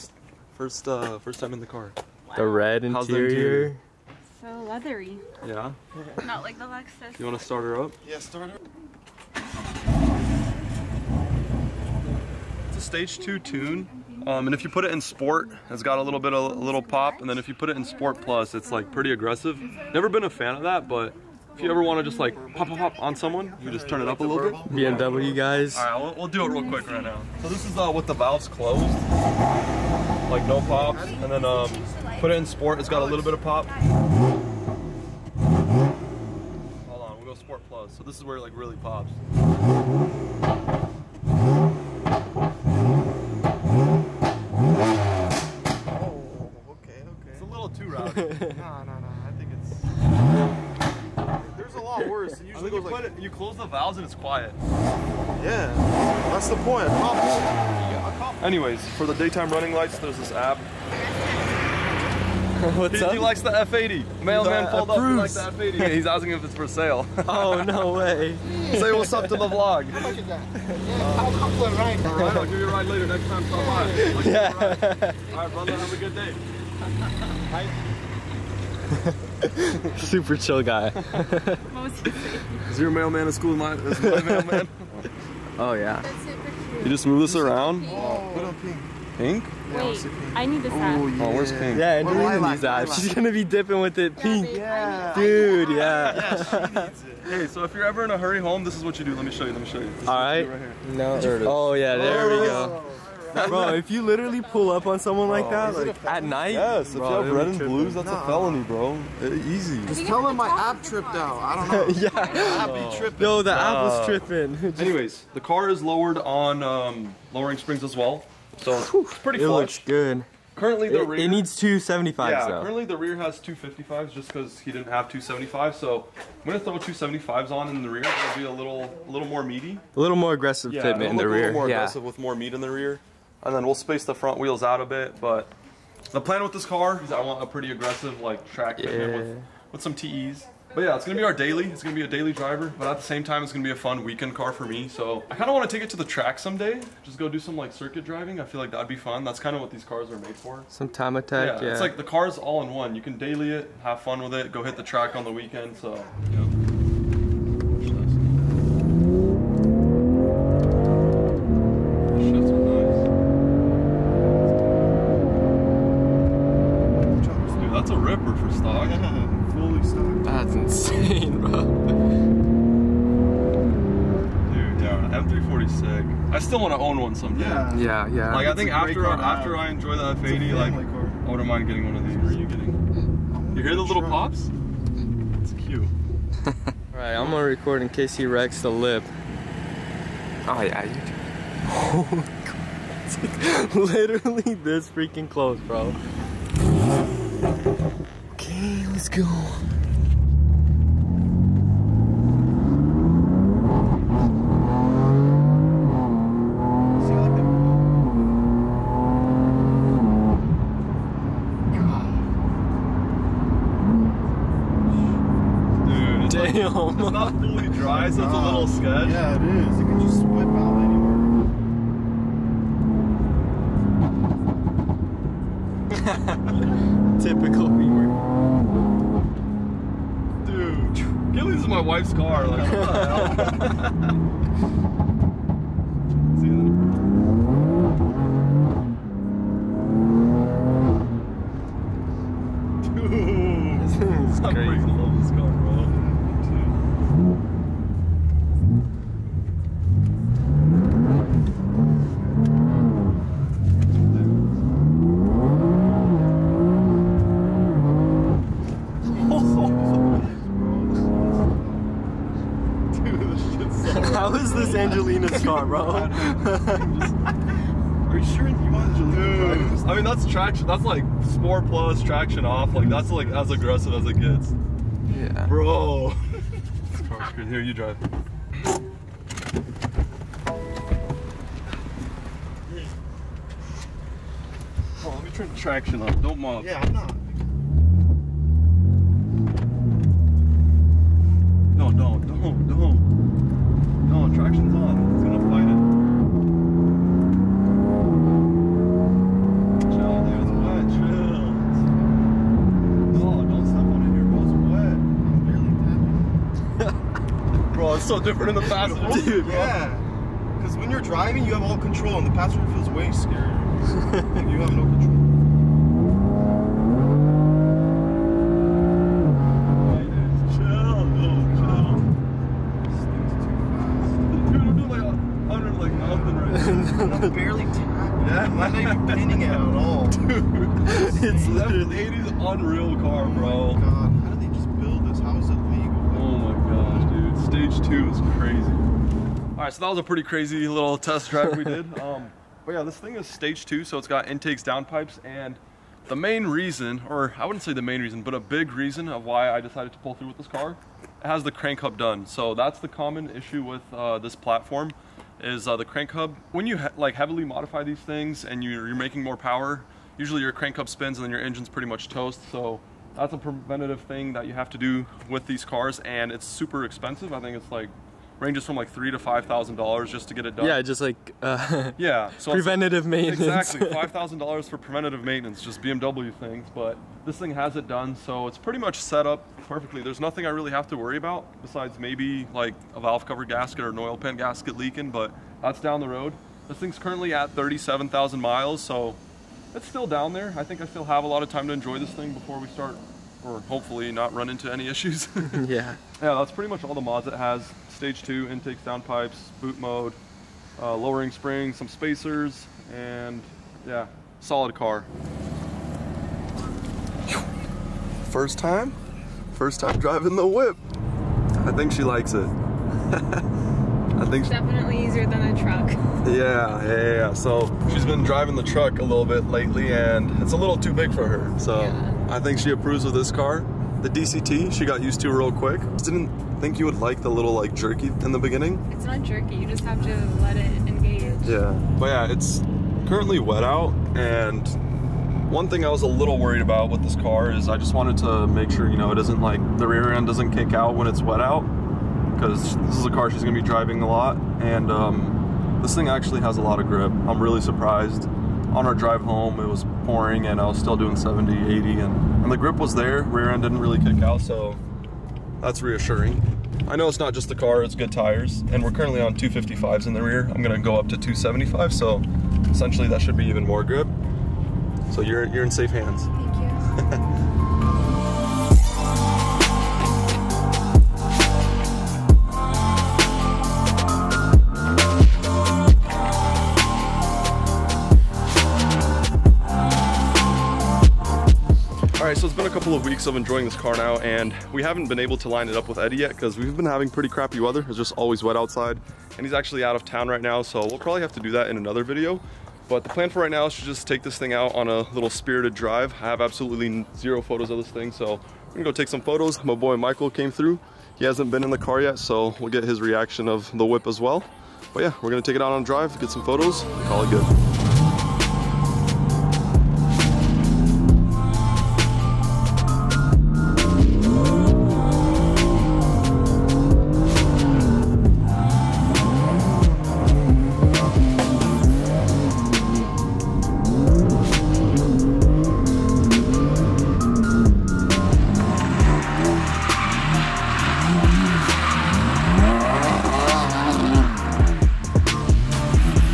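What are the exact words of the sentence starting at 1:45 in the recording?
that, like at night, yes, bro, if you have red and blues, that's a felony, bro.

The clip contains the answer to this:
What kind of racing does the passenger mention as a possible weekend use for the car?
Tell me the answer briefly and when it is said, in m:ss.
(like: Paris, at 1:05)
Time attack, at 2:30.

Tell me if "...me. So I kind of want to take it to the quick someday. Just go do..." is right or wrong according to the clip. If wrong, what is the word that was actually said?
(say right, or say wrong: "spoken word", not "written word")
wrong: "track", not "quick".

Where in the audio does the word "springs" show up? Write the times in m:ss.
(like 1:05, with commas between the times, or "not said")
1:57, 6:41.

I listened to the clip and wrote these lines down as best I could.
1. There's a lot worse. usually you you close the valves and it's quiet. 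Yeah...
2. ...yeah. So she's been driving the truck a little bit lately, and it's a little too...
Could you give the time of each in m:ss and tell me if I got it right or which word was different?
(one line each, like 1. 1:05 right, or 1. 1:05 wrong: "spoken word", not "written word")
1. 0:51 right
2. 6:57 right.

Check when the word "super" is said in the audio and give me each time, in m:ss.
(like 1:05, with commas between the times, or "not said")
1:19, 6:06.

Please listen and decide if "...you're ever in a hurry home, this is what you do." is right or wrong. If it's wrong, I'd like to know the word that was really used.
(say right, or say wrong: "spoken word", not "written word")
right.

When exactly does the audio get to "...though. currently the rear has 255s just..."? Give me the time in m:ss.
2:02.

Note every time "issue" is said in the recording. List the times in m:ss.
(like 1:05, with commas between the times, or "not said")
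5:53, 6:34.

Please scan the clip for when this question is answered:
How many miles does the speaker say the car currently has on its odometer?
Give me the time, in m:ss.
6:27.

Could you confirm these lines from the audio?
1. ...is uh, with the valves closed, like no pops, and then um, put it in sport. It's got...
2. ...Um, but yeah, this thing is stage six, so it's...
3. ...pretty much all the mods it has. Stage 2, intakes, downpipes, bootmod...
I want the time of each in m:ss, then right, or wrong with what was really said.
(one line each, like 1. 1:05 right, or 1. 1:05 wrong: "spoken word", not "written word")
1. 0:27 right
2. 5:41 wrong: "two", not "six"
3. 6:36 right.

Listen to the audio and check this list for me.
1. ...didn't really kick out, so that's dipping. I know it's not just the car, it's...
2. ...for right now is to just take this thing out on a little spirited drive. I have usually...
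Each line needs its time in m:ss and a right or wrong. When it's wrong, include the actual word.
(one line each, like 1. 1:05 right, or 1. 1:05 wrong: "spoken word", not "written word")
1. 7:33 wrong: "reassuring", not "dipping"
2. 8:13 wrong: "absolutely", not "usually".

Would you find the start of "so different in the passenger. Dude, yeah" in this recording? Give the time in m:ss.
5:08.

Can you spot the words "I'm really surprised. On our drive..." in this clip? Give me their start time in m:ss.
7:27.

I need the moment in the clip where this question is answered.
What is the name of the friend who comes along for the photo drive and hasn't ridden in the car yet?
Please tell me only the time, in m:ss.
8:19.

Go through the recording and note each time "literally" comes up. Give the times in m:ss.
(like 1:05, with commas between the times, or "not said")
1:44, 3:13.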